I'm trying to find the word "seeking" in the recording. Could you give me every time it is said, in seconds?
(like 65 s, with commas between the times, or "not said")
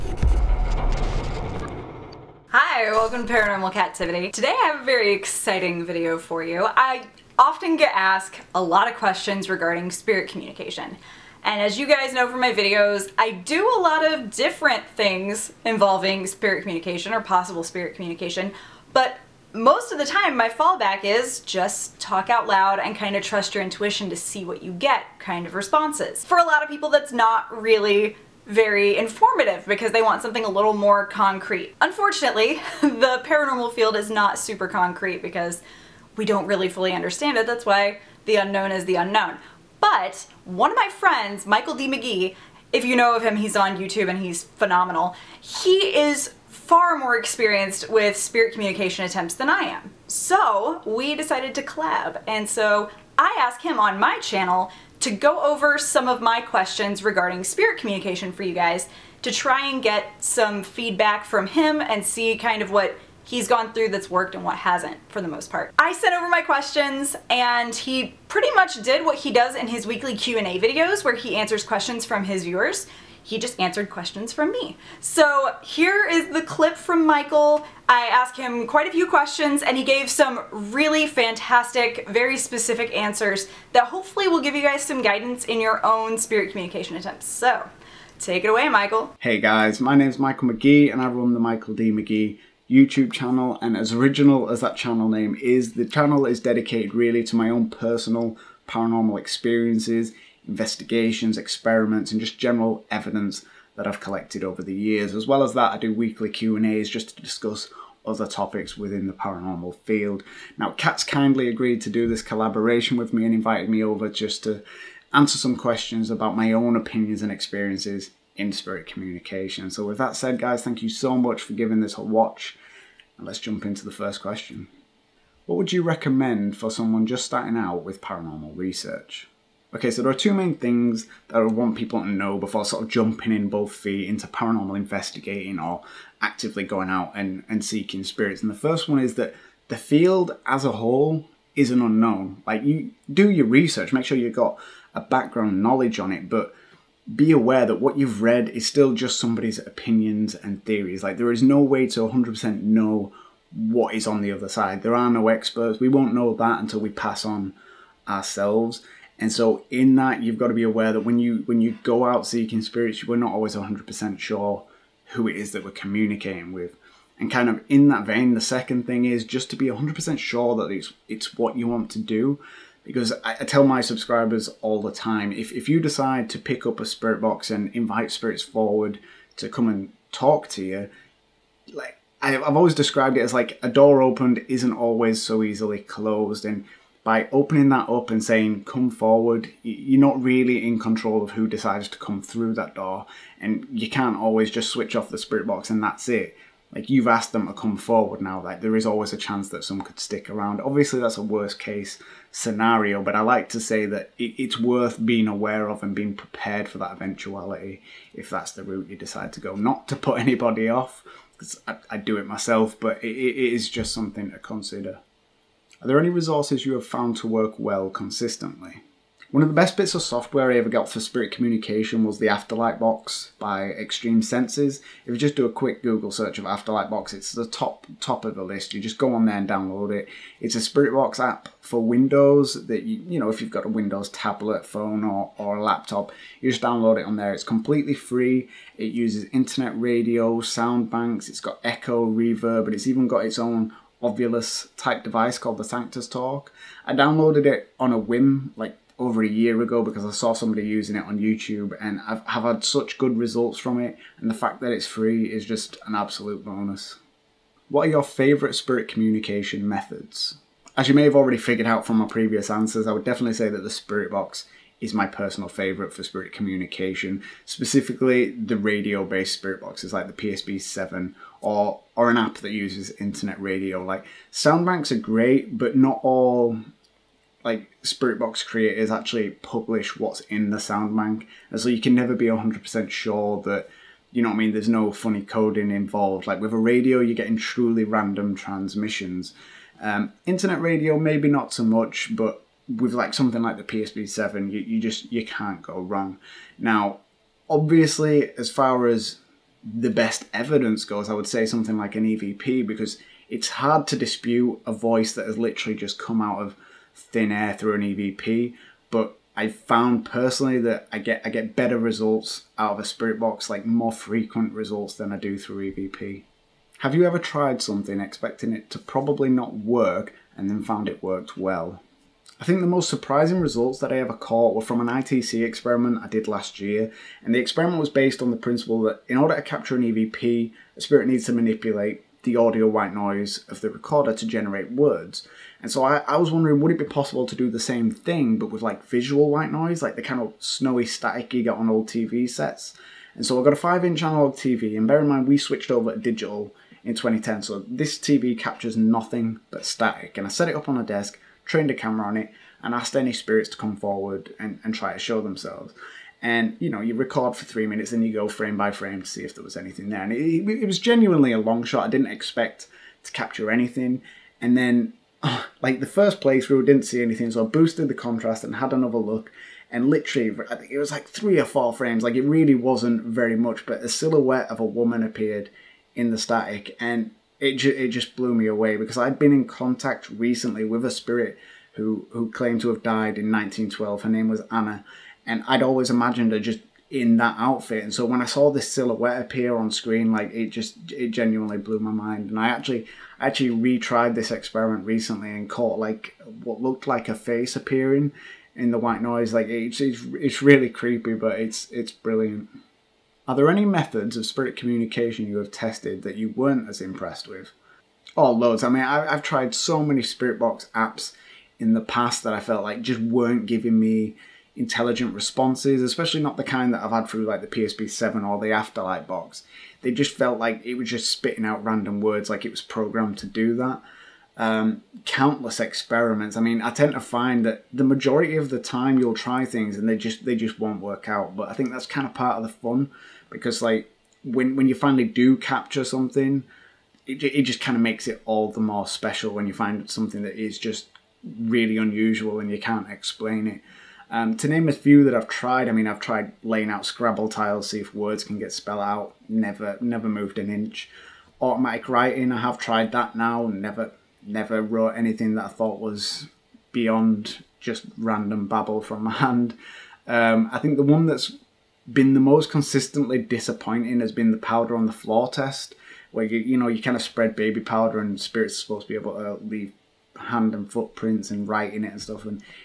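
137 s, 162 s.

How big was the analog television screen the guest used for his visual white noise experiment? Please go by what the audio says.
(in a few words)
5 inch.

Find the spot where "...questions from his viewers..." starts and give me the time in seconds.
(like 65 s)
71 s.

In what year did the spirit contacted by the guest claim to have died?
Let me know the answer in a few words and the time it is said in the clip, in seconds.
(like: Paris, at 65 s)
1912, at 383 s.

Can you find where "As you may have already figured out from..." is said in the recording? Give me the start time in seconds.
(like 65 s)
260 s.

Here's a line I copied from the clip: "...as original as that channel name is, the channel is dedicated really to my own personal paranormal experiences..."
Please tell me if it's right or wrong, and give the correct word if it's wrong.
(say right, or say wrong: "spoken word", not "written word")
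right.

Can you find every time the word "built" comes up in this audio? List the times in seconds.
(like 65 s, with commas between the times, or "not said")
not said.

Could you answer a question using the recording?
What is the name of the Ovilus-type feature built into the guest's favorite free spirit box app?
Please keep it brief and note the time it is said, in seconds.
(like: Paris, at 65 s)
Sanctus Talk, at 245 s.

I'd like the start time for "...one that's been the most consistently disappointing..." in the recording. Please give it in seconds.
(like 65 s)
460 s.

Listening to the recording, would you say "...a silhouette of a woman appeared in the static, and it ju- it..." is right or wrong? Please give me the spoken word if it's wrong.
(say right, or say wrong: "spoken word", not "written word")
right.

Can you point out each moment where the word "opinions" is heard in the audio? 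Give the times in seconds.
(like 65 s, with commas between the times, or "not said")
116 s, 149 s.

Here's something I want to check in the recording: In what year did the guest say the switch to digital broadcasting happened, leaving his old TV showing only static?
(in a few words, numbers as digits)
2010.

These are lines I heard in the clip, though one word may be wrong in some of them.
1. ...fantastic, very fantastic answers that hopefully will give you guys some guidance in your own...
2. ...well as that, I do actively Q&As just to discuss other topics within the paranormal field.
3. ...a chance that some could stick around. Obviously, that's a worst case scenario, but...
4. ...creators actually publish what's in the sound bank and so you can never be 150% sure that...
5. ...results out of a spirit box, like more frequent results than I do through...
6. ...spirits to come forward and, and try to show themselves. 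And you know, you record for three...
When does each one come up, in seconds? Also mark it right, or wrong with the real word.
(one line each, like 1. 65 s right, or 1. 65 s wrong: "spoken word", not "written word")
1. 81 s wrong: "specific", not "fantastic"
2. 105 s wrong: "weekly", not "actively"
3. 199 s right
4. 278 s wrong: "100", not "150"
5. 311 s right
6. 353 s right.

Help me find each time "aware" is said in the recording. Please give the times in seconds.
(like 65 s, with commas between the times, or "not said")
147 s, 160 s, 205 s.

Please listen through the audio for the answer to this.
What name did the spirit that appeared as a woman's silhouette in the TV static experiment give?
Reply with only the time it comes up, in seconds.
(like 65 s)
384 s.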